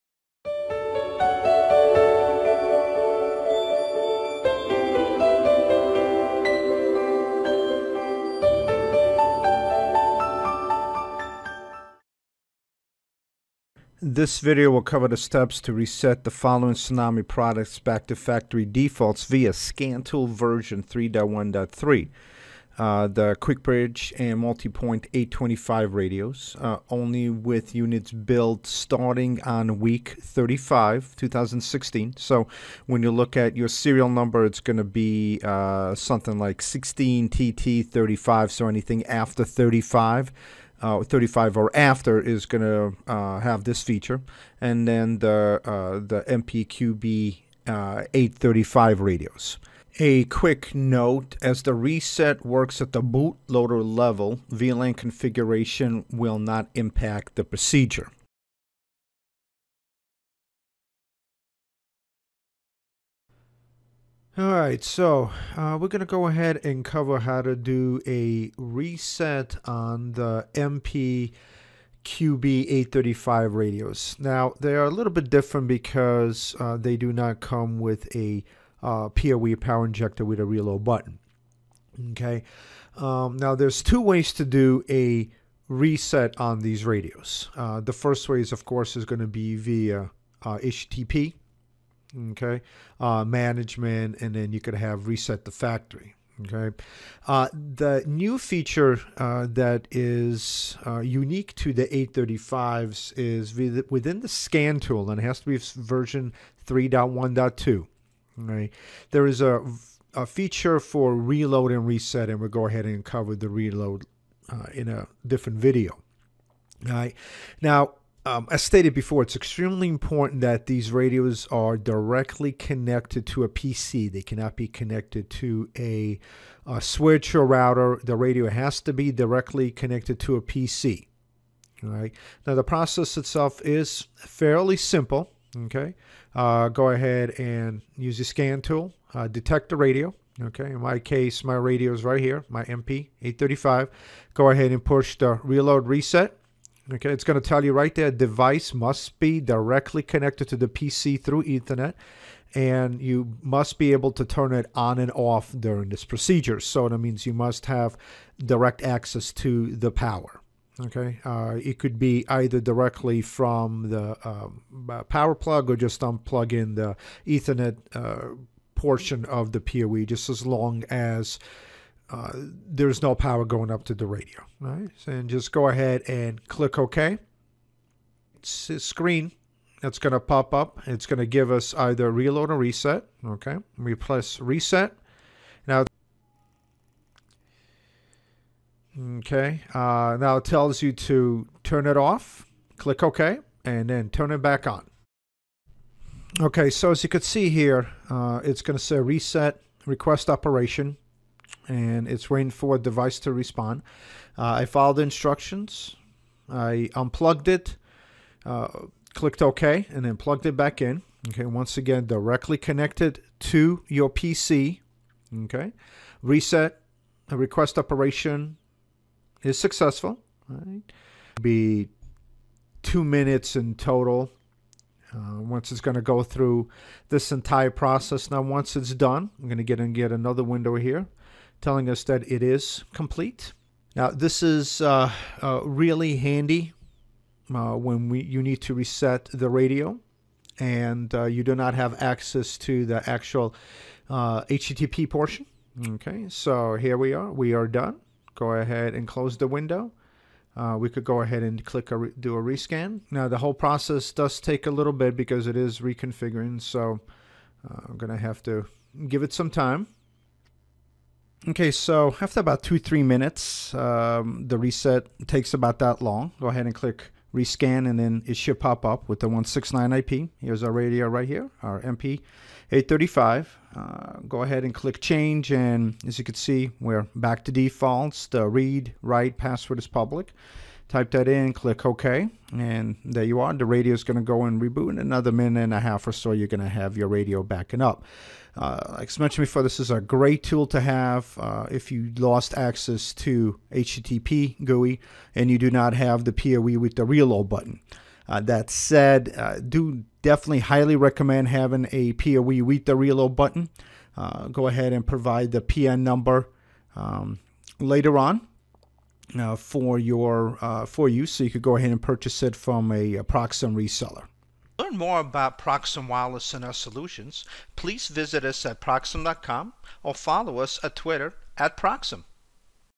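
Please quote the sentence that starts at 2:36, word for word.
So that means you must have direct access to the power.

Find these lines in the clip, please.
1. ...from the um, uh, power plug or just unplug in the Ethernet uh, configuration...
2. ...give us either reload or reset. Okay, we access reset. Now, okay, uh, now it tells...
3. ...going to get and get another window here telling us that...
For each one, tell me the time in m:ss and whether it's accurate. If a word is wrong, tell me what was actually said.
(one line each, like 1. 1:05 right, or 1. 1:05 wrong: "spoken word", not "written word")
1. 2:43 wrong: "portion", not "configuration"
2. 3:01 wrong: "press", not "access"
3. 3:49 right.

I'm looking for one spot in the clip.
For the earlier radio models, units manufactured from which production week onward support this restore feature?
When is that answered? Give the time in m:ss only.
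0:29.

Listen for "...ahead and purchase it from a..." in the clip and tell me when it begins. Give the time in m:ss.
5:11.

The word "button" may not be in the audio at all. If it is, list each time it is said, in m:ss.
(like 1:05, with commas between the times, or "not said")
1:20, 4:57, 5:03.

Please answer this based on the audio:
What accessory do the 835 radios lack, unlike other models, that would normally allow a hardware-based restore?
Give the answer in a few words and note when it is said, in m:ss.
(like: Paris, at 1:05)
PoE power injector, at 1:19.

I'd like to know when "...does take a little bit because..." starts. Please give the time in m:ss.
4:14.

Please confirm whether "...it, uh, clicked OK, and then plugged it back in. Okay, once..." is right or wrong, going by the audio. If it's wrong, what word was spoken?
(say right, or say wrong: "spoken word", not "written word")
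right.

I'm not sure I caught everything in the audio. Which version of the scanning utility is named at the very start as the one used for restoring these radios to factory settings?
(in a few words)
3.1.3.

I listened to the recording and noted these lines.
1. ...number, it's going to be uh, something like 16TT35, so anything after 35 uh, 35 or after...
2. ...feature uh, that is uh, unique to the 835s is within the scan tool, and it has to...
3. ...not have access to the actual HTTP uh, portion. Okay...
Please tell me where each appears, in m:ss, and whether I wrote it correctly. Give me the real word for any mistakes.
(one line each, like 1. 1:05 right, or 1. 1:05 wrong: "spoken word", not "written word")
1. 0:34 right
2. 1:38 right
3. 4:01 right.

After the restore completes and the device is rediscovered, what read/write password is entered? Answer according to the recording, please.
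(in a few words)
public.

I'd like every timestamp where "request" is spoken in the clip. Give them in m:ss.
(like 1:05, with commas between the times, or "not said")
3:19, 3:37.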